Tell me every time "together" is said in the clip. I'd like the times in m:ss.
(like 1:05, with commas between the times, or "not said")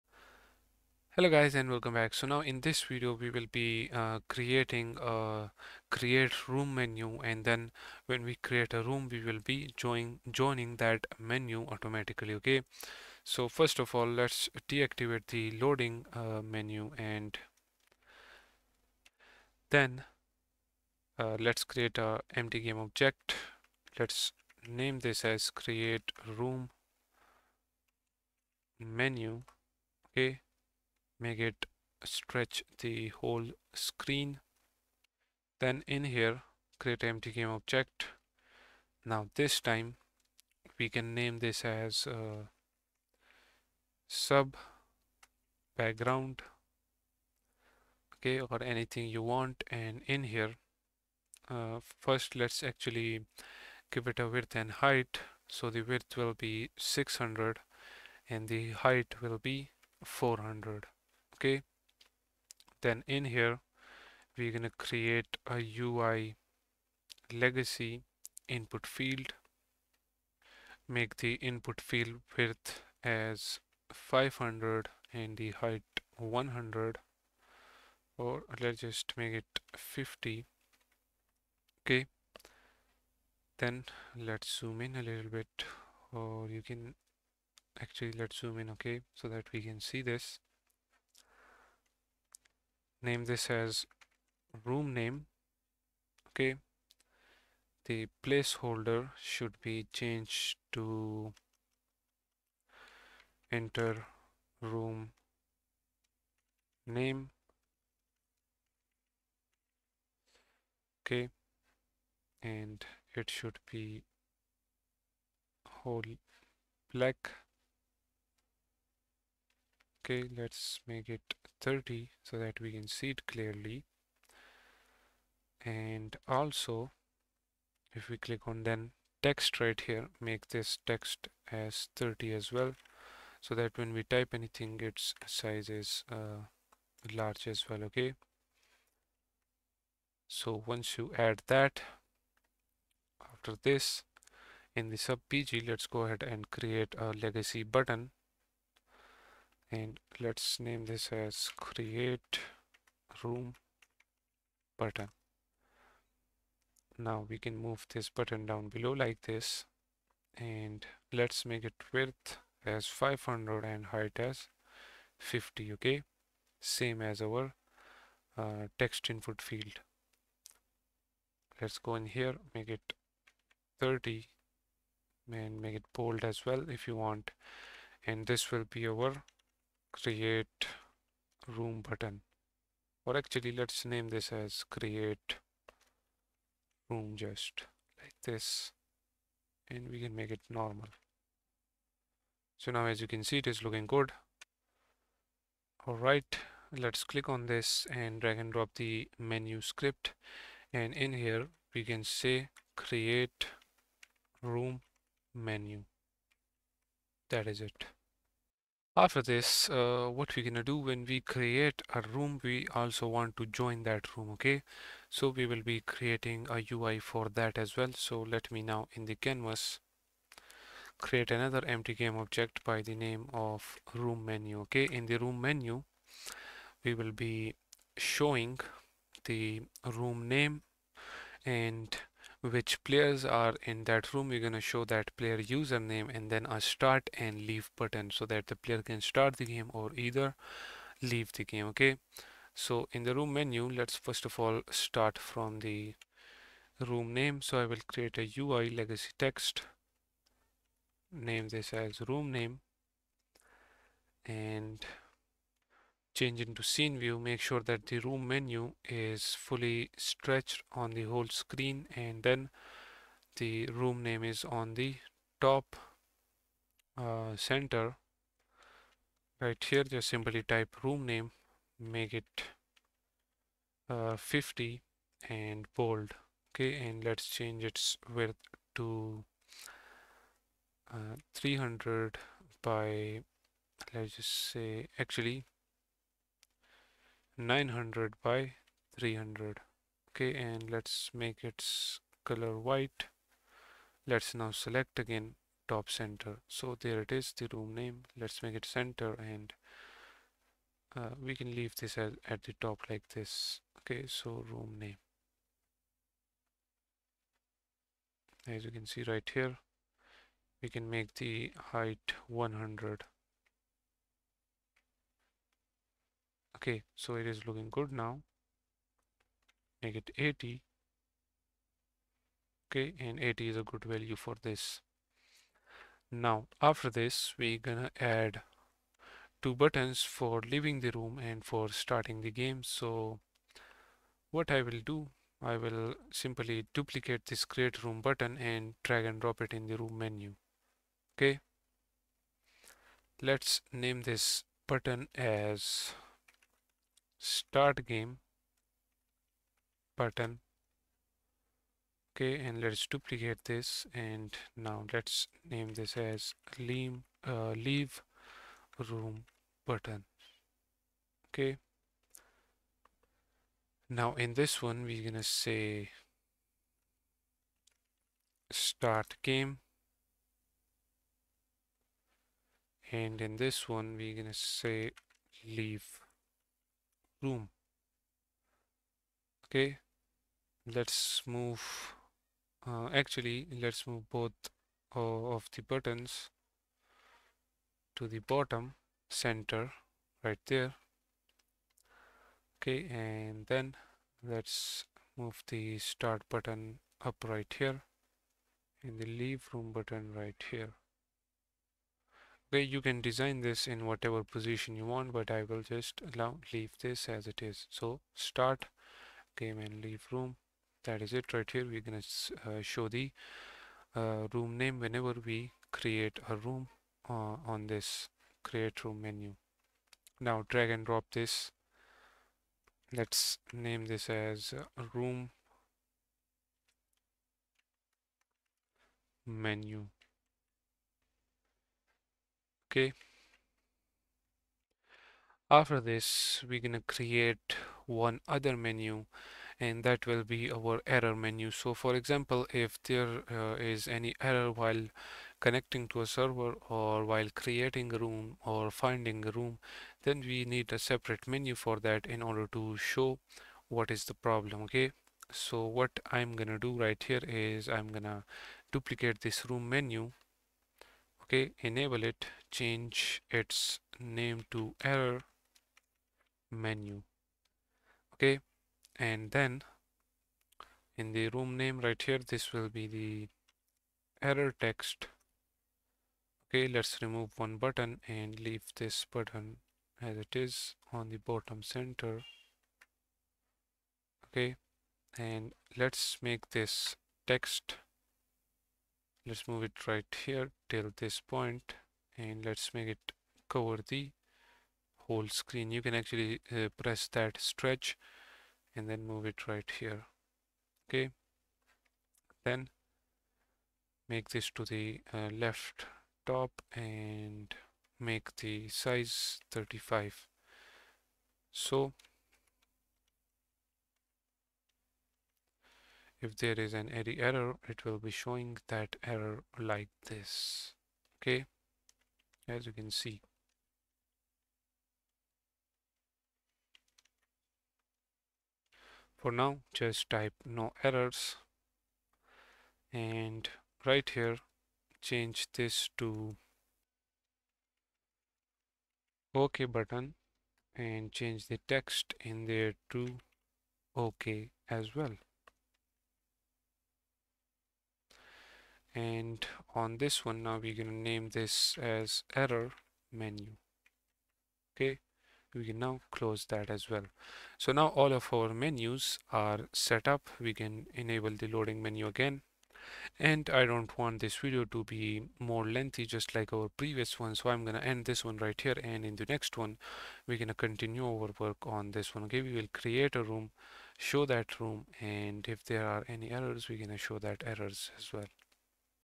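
not said.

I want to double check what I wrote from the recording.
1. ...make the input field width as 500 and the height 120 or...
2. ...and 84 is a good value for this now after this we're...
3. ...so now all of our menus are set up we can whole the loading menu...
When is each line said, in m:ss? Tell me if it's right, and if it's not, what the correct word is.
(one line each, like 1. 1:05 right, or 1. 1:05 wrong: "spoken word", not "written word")
1. 1:10 wrong: "100", not "120"
2. 5:22 wrong: "80", not "84"
3. 9:17 wrong: "enable", not "whole".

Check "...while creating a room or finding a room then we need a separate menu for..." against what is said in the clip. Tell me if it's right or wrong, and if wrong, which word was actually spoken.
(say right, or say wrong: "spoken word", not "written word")
right.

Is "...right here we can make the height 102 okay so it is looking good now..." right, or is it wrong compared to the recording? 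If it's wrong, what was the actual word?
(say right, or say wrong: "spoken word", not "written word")
wrong: "100", not "102".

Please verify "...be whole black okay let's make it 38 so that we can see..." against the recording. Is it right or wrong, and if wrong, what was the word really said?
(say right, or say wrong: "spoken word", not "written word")
wrong: "30", not "38".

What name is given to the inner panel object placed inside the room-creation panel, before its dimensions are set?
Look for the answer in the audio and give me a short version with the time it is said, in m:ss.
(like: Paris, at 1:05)
sub background, at 0:44.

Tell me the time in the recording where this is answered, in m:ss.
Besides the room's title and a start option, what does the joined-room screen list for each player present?
3:55.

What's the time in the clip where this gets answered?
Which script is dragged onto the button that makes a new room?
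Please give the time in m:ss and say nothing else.
3:19.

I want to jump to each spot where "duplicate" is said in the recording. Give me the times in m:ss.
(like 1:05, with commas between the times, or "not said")
5:36, 5:52, 7:38.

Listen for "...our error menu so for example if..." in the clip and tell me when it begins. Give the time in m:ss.
7:20.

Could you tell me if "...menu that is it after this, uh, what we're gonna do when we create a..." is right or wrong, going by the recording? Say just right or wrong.
right.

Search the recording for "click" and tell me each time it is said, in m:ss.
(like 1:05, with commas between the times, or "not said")
2:08, 3:17.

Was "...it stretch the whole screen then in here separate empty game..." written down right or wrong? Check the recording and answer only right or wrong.
wrong.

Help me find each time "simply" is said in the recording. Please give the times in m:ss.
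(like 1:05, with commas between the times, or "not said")
4:30, 5:36.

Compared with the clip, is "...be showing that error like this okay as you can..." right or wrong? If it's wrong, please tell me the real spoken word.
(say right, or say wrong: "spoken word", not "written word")
right.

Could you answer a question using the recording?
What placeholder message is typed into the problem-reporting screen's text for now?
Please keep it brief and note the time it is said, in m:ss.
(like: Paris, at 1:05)
No errors, at 8:50.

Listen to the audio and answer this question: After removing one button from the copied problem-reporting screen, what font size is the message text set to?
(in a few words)
35.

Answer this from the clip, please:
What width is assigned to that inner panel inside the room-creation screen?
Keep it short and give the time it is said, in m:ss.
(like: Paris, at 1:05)
600, at 0:56.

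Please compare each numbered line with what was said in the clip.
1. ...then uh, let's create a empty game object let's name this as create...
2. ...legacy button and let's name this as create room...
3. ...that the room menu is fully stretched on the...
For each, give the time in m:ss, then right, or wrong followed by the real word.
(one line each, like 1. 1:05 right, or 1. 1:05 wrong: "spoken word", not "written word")
1. 0:19 right
2. 2:27 right
3. 4:17 right.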